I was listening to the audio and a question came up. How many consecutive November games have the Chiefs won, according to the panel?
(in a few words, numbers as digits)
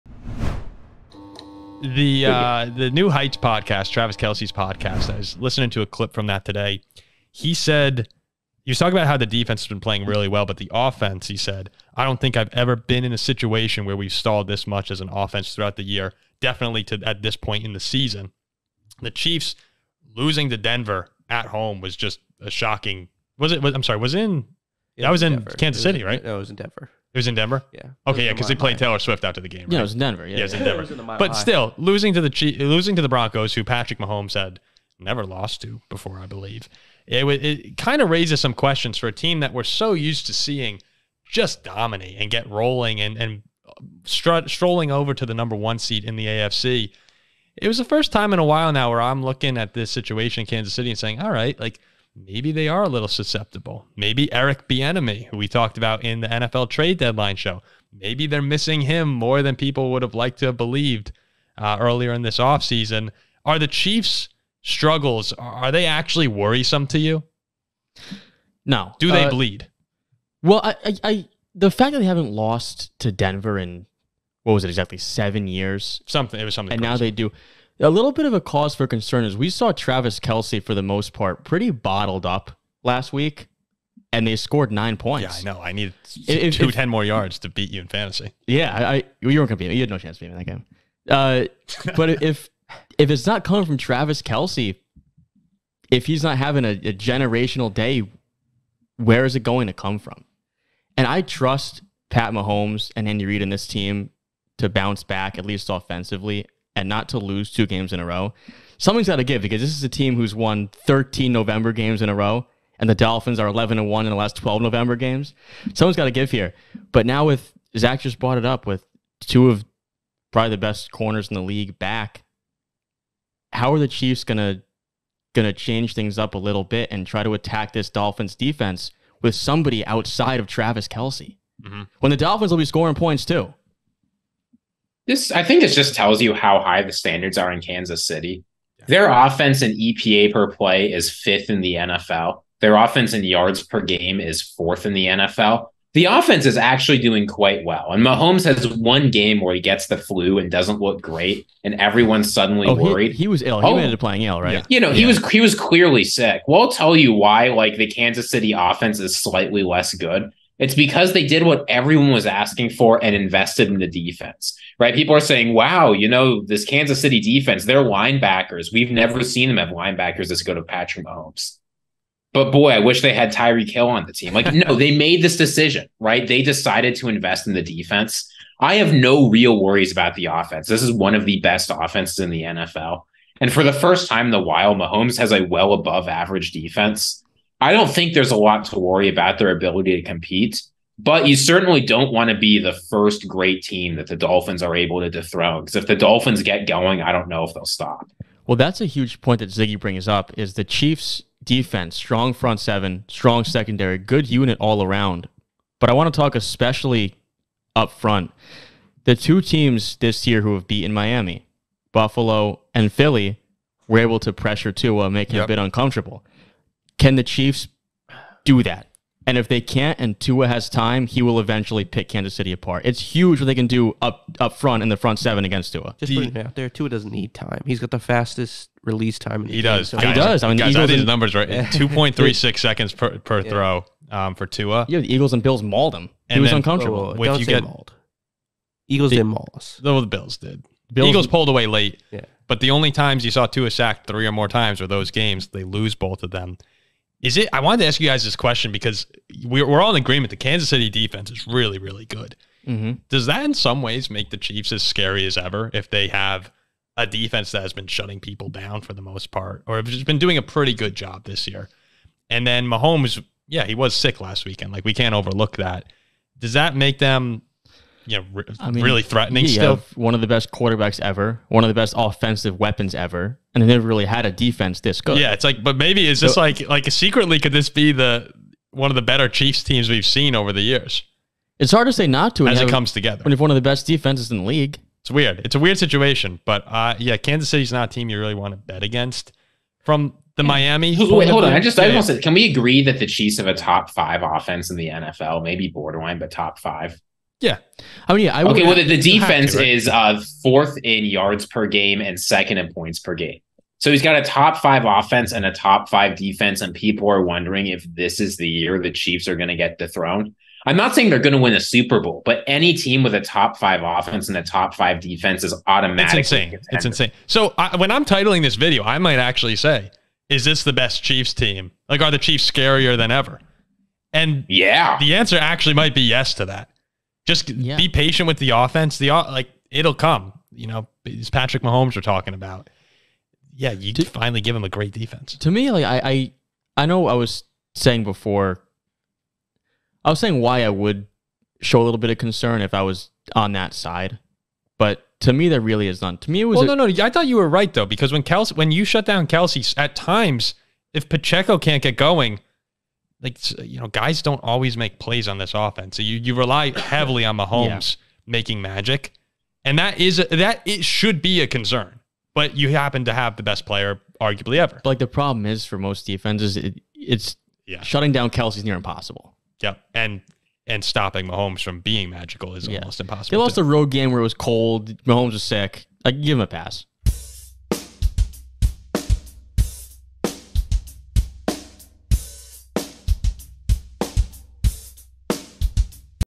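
13.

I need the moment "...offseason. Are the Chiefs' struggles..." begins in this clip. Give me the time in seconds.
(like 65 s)
62 s.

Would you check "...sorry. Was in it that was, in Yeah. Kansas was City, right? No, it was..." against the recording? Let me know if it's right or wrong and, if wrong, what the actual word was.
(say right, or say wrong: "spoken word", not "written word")
wrong: "Denver", not "Yeah".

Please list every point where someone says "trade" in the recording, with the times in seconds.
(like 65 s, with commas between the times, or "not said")
56 s.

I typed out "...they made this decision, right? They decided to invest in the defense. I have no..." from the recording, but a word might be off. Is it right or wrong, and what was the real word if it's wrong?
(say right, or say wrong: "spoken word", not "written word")
right.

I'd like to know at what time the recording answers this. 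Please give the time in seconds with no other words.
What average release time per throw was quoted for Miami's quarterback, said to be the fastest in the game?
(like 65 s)
231 s.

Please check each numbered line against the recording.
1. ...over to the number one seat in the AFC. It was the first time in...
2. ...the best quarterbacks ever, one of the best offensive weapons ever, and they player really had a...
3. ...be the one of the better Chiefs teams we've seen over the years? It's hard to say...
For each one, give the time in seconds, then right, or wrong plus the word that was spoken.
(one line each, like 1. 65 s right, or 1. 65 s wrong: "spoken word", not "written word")
1. 44 s right
2. 270 s wrong: "never", not "player"
3. 277 s right.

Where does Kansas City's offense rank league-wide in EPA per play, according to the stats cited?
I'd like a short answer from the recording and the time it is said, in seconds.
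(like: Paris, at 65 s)
Fifth, at 141 s.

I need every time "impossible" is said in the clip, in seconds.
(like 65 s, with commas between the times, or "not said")
368 s, 372 s.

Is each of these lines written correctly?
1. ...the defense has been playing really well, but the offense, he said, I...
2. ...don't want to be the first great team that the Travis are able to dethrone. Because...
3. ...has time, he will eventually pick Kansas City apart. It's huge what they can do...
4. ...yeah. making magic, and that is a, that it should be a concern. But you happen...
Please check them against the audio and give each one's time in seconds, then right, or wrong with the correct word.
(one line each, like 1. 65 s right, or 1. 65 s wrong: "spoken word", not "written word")
1. 9 s right
2. 191 s wrong: "Dolphins", not "Travis"
3. 220 s right
4. 357 s right.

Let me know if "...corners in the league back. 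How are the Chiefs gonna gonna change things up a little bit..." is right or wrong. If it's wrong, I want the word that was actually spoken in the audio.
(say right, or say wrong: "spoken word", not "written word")
right.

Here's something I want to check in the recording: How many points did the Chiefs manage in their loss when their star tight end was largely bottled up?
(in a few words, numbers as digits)
9.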